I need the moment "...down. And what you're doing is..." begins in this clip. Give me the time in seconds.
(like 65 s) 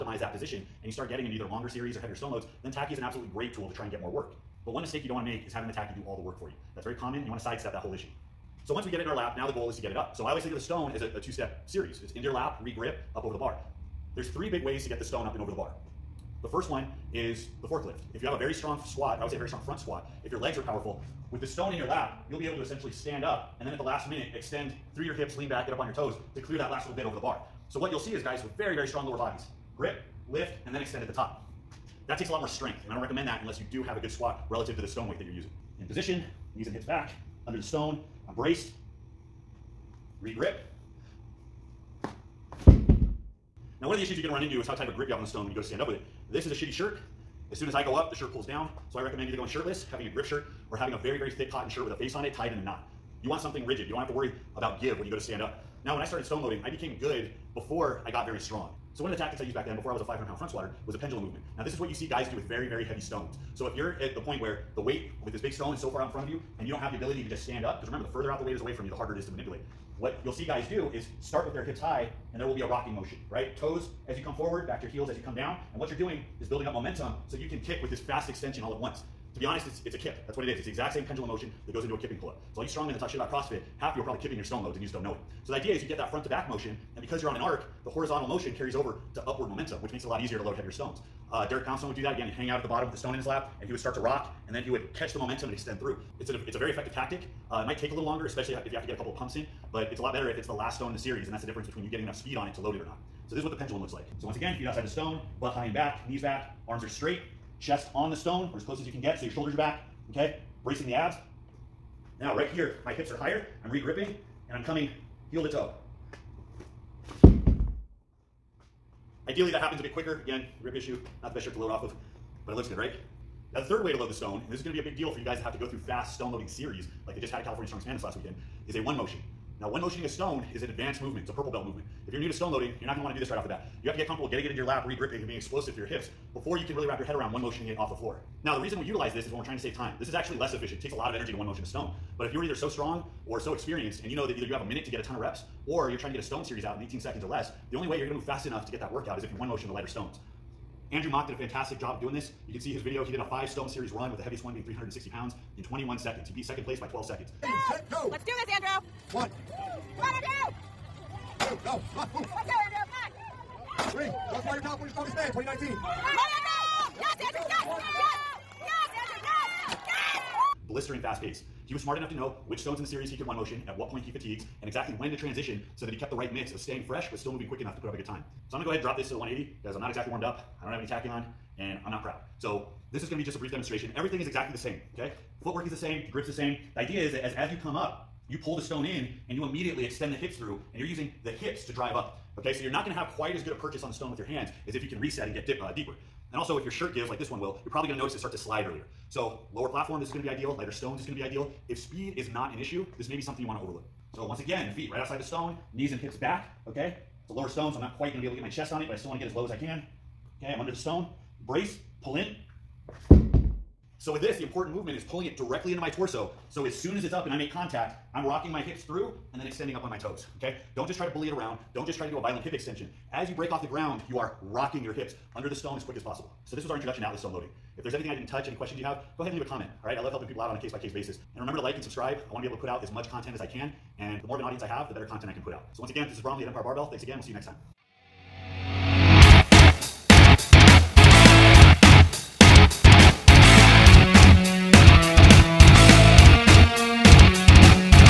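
75 s.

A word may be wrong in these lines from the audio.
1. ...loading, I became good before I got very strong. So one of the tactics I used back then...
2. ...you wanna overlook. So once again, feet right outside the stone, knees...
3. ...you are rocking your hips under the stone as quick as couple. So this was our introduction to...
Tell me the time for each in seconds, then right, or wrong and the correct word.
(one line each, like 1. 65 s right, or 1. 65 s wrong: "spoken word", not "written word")
1. 56 s right
2. 203 s right
3. 224 s wrong: "possible", not "couple".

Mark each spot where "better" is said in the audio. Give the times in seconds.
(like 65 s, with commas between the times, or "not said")
100 s, 234 s.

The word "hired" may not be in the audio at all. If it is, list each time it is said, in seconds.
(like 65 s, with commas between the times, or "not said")
not said.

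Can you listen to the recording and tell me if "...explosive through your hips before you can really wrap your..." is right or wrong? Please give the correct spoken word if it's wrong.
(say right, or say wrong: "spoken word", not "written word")
right.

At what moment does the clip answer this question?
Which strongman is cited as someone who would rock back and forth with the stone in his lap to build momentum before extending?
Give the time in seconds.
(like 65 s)
91 s.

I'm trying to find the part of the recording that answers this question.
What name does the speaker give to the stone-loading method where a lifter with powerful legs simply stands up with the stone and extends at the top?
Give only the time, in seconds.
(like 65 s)
17 s.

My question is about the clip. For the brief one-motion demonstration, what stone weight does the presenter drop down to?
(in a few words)
180.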